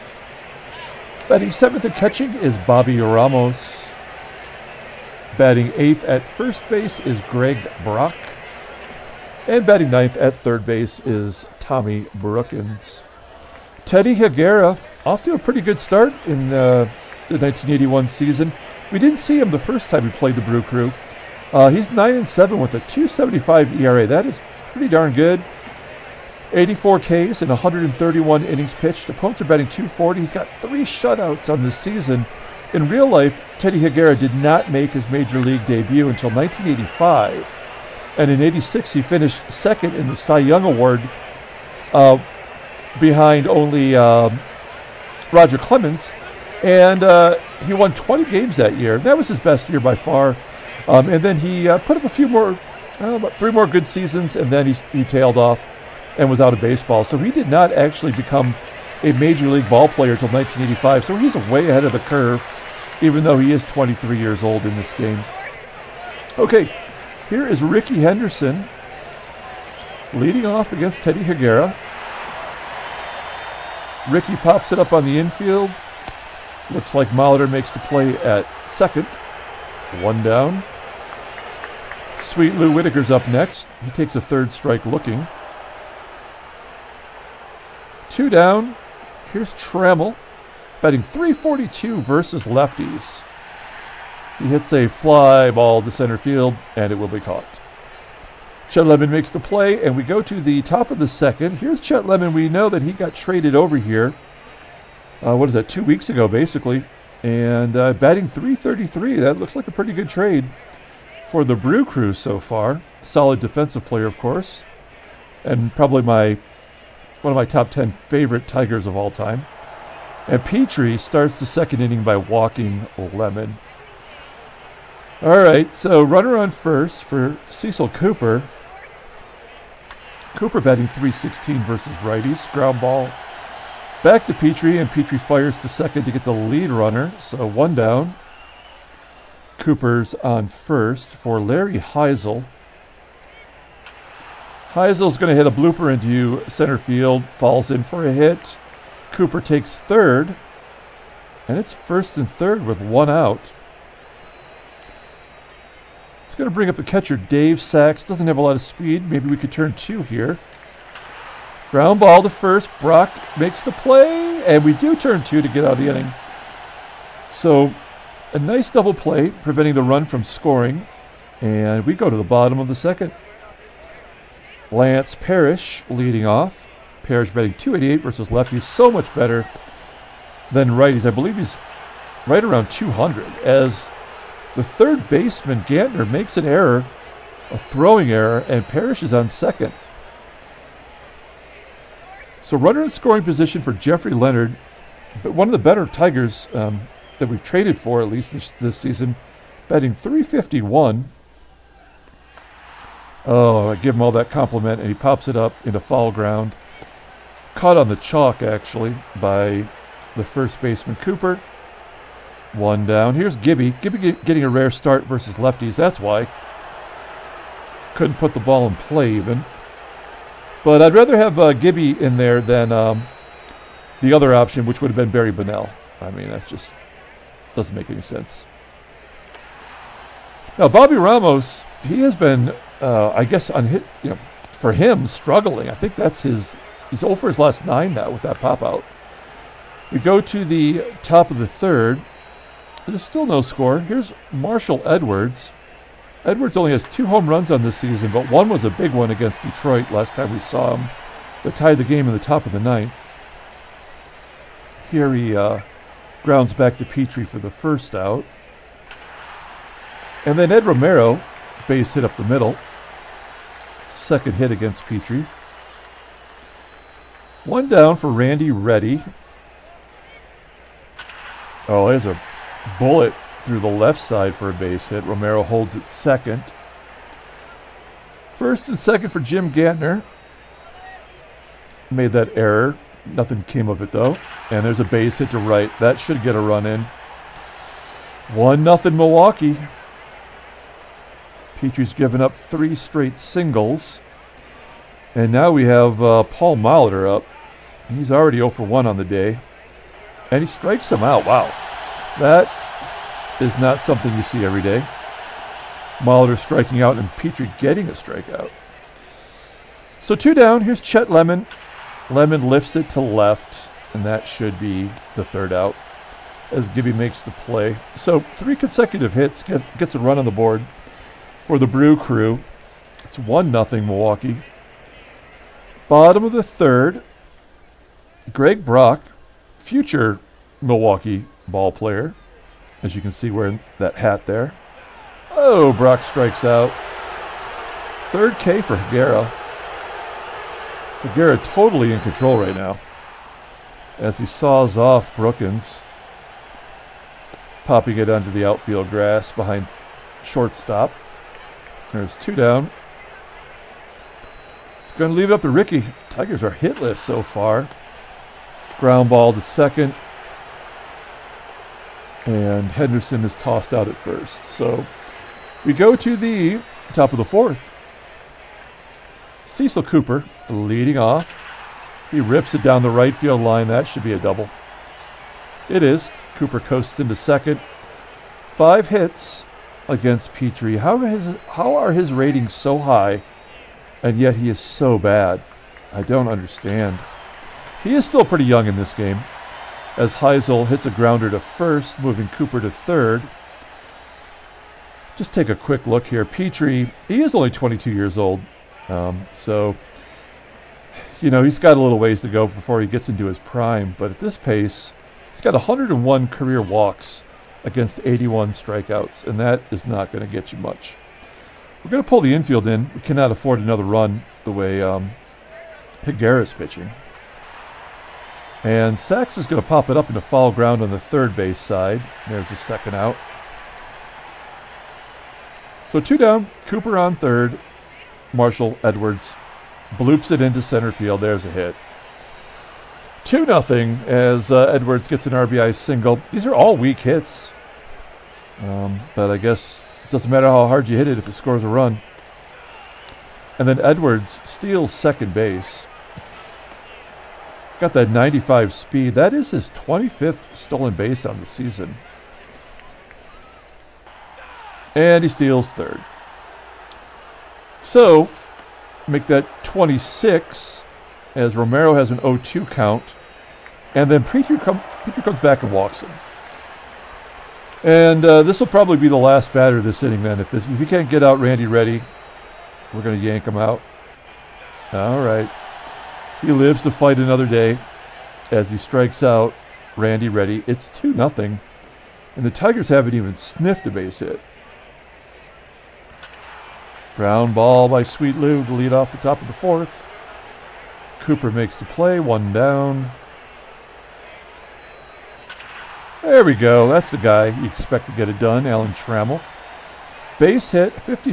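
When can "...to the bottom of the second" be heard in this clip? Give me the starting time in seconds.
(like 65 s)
172 s.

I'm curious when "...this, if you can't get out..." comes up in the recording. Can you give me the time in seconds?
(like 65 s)
470 s.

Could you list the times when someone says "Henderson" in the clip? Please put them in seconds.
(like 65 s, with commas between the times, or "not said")
67 s, 362 s.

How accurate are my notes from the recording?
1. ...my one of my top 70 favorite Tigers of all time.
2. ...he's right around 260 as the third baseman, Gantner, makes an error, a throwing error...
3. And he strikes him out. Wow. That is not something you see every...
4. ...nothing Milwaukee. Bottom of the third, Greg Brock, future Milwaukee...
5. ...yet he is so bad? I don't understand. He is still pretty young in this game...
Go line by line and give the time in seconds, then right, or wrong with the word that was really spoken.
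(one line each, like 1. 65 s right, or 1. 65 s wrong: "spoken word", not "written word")
1. 116 s wrong: "10", not "70"
2. 181 s wrong: "200", not "260"
3. 300 s right
4. 323 s right
5. 384 s right.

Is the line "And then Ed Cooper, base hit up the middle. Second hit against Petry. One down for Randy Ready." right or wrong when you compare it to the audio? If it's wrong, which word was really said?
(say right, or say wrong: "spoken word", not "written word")
wrong: "Romero", not "Cooper".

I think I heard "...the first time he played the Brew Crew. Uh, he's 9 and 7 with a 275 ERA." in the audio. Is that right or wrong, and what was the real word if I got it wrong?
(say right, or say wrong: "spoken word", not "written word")
right.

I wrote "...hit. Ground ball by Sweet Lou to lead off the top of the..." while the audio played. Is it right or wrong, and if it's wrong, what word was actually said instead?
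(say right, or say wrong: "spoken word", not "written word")
right.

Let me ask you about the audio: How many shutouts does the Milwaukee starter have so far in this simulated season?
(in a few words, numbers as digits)
3.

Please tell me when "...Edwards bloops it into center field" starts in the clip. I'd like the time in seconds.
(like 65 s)
428 s.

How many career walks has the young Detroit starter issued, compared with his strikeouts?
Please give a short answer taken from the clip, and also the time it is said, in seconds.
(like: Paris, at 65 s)
101, at 405 s.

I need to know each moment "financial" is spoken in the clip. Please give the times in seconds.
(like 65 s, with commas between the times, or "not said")
not said.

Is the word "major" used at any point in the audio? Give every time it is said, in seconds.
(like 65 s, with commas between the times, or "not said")
35 s, 59 s.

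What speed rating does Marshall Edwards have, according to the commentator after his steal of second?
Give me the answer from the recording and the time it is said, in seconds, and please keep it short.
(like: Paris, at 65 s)
95, at 448 s.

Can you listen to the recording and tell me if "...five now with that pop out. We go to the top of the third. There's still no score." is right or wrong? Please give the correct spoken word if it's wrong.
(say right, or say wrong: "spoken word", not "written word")
wrong: "nine", not "five".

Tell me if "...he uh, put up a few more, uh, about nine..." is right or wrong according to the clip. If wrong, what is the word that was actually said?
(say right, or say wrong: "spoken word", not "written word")
wrong: "three", not "nine".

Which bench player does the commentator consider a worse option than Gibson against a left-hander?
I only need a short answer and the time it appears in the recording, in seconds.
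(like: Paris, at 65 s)
Barry Bonnell, at 225 s.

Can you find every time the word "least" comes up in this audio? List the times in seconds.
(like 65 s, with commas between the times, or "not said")
198 s.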